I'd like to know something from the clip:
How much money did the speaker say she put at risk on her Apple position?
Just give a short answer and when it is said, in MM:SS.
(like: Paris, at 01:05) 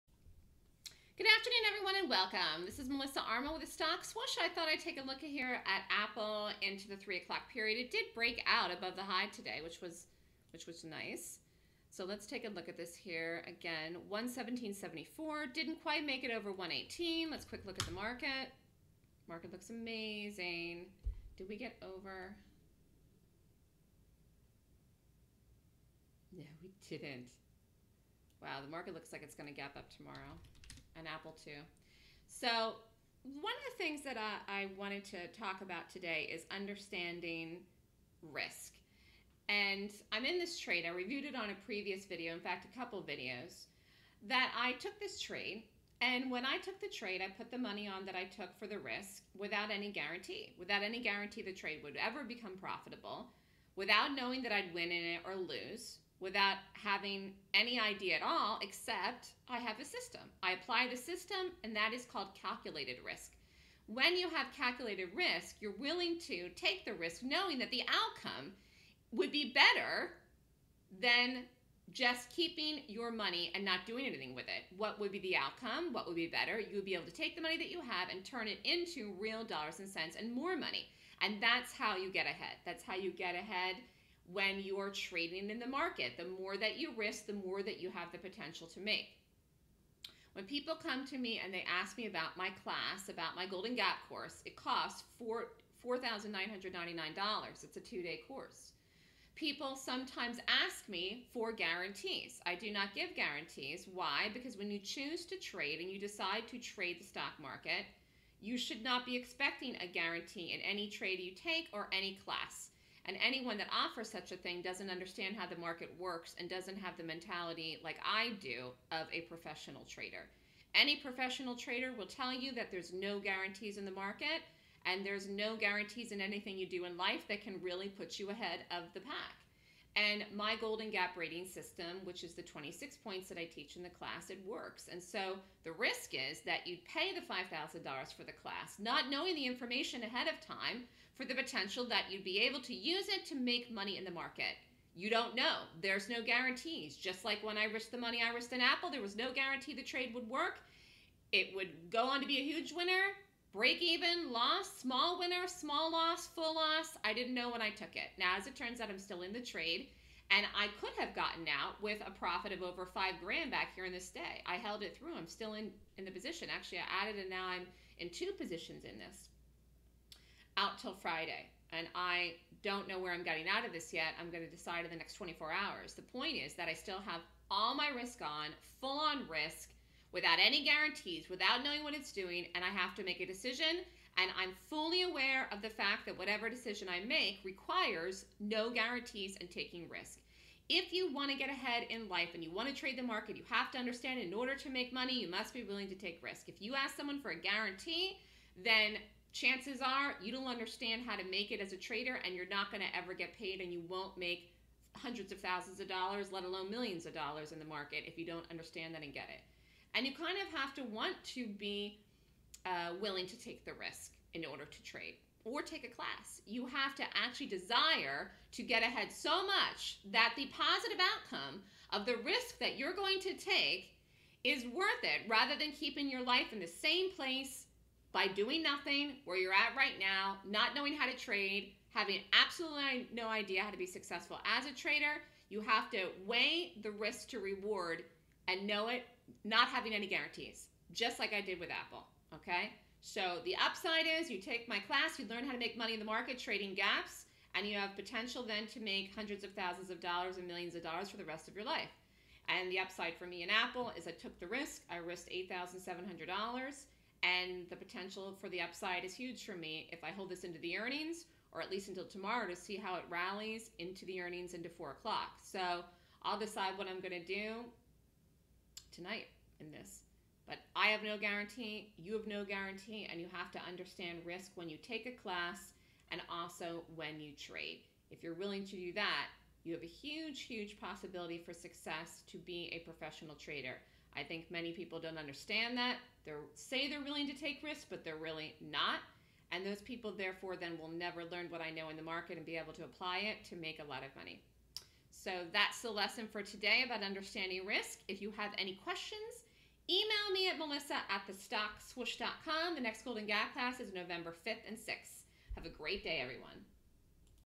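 $8,700, at 04:15.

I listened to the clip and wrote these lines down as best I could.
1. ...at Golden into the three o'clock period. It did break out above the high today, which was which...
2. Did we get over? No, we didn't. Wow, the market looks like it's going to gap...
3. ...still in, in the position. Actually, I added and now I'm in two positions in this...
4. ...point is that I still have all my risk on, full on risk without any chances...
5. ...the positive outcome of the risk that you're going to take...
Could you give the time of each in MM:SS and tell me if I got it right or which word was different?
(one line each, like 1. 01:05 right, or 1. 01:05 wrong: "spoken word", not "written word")
1. 00:05 wrong: "Apple", not "Golden"
2. 00:21 right
3. 02:45 right
4. 02:56 wrong: "guarantees", not "chances"
5. 03:40 right.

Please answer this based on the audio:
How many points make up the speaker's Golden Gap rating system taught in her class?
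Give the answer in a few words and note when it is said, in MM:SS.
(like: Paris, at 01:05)
26, at 02:12.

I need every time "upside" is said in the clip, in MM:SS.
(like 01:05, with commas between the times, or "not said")
04:03, 04:12, 04:18.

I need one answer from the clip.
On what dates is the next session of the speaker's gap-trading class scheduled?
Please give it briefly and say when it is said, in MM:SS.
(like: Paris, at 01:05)
November 5th and 6th, at 05:03.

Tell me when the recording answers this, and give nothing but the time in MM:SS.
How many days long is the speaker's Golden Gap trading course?
01:37.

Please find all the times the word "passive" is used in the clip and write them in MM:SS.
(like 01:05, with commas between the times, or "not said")
not said.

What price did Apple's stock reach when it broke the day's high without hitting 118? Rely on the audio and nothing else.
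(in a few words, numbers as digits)
117.74.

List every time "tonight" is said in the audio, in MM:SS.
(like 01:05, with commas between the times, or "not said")
04:28.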